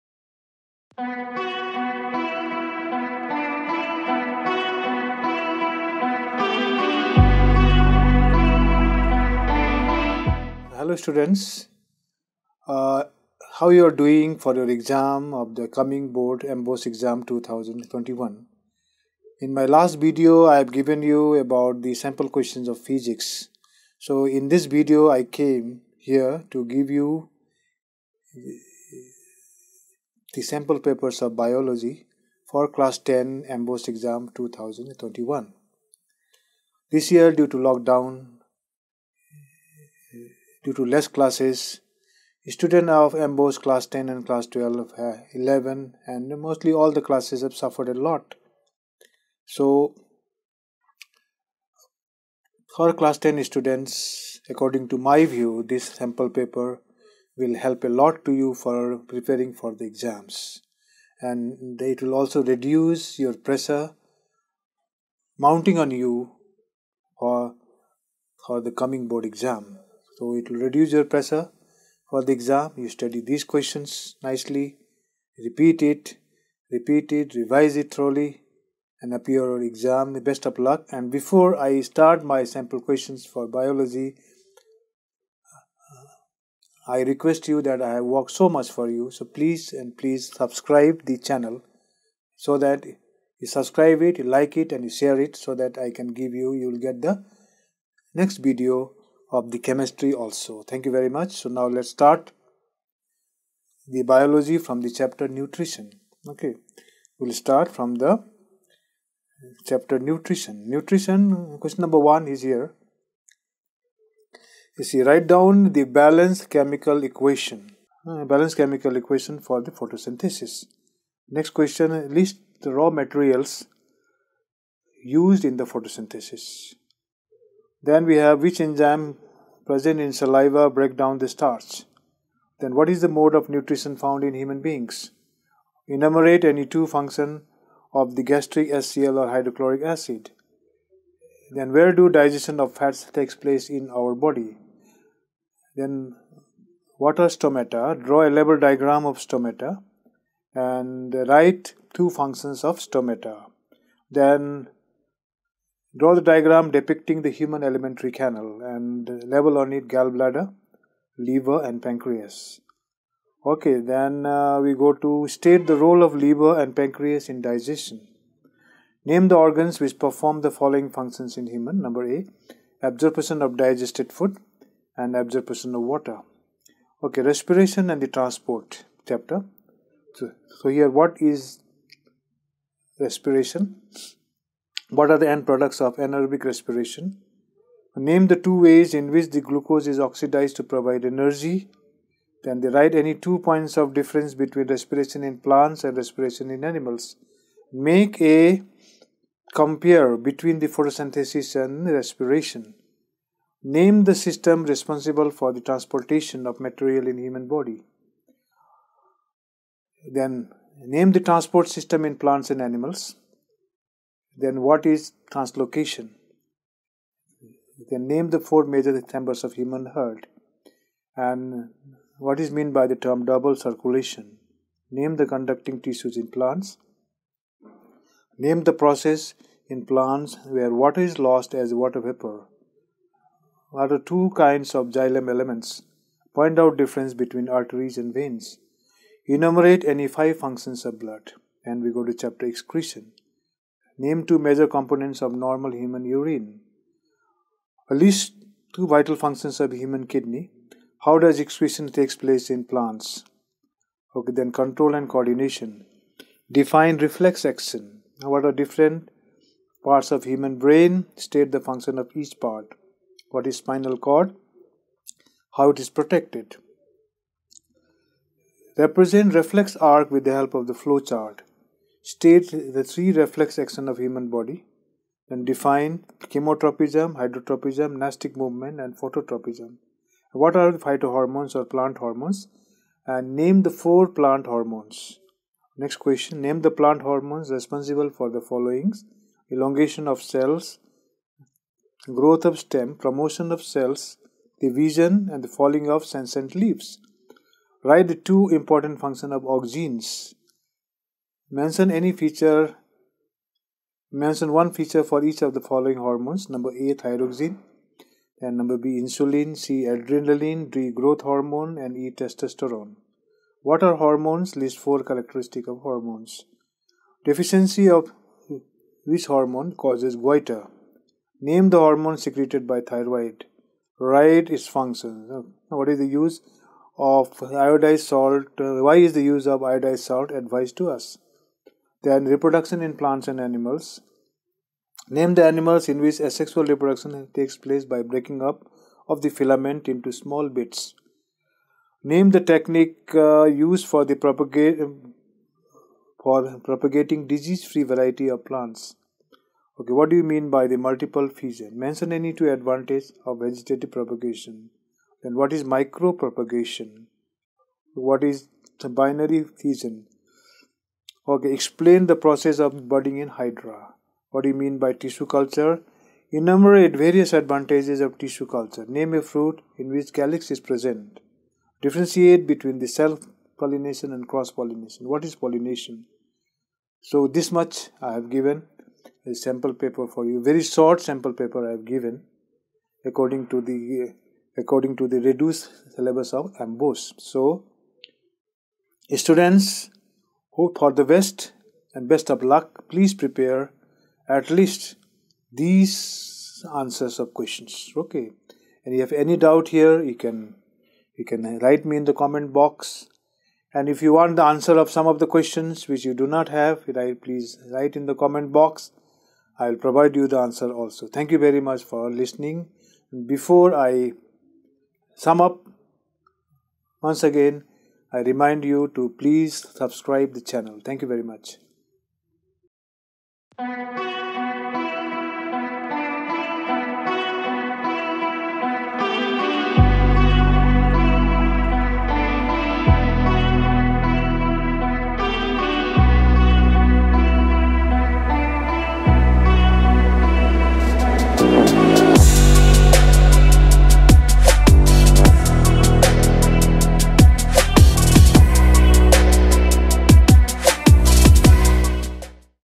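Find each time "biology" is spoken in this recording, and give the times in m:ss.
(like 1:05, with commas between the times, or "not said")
0:31, 1:23, 1:44.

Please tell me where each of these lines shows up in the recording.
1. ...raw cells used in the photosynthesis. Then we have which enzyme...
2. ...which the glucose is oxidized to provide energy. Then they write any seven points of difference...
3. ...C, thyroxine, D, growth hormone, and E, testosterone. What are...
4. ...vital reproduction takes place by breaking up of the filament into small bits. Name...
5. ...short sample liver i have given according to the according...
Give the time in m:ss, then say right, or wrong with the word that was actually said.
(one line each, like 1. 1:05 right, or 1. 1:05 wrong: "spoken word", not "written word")
1. 2:02 wrong: "materials", not "cells"
2. 3:09 wrong: "two", not "seven"
3. 5:09 wrong: "adrenaline", not "thyroxine"
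4. 5:36 wrong: "asexual", not "vital"
5. 6:20 wrong: "paper", not "liver".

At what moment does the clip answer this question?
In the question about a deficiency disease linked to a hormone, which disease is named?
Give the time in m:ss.
5:20.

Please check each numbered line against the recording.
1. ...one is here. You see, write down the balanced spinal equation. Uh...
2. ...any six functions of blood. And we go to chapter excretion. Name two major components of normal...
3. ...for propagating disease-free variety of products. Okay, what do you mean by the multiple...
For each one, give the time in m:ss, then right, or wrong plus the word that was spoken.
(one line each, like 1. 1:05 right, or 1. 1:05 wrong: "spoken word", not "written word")
1. 1:51 wrong: "chemical", not "spinal"
2. 3:59 wrong: "five", not "six"
3. 5:46 wrong: "plants", not "products".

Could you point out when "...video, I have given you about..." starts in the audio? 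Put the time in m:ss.
0:19.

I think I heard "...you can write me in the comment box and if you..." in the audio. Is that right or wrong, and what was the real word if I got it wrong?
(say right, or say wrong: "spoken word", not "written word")
right.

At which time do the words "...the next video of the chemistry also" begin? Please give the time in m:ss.
1:37.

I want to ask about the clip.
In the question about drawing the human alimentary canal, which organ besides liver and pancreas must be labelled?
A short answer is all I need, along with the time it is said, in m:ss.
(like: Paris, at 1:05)
Gallbladder, at 2:39.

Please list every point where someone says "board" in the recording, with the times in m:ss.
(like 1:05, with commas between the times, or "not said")
0:16, 1:09.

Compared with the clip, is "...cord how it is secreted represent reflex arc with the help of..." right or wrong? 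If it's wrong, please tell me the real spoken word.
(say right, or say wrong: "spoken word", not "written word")
wrong: "protected", not "secreted".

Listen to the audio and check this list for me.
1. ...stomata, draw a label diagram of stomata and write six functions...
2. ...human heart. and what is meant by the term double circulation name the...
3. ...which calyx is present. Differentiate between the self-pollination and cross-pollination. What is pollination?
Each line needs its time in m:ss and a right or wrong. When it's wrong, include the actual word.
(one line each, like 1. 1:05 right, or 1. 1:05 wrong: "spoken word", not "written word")
1. 2:27 wrong: "two", not "six"
2. 3:39 right
3. 6:09 right.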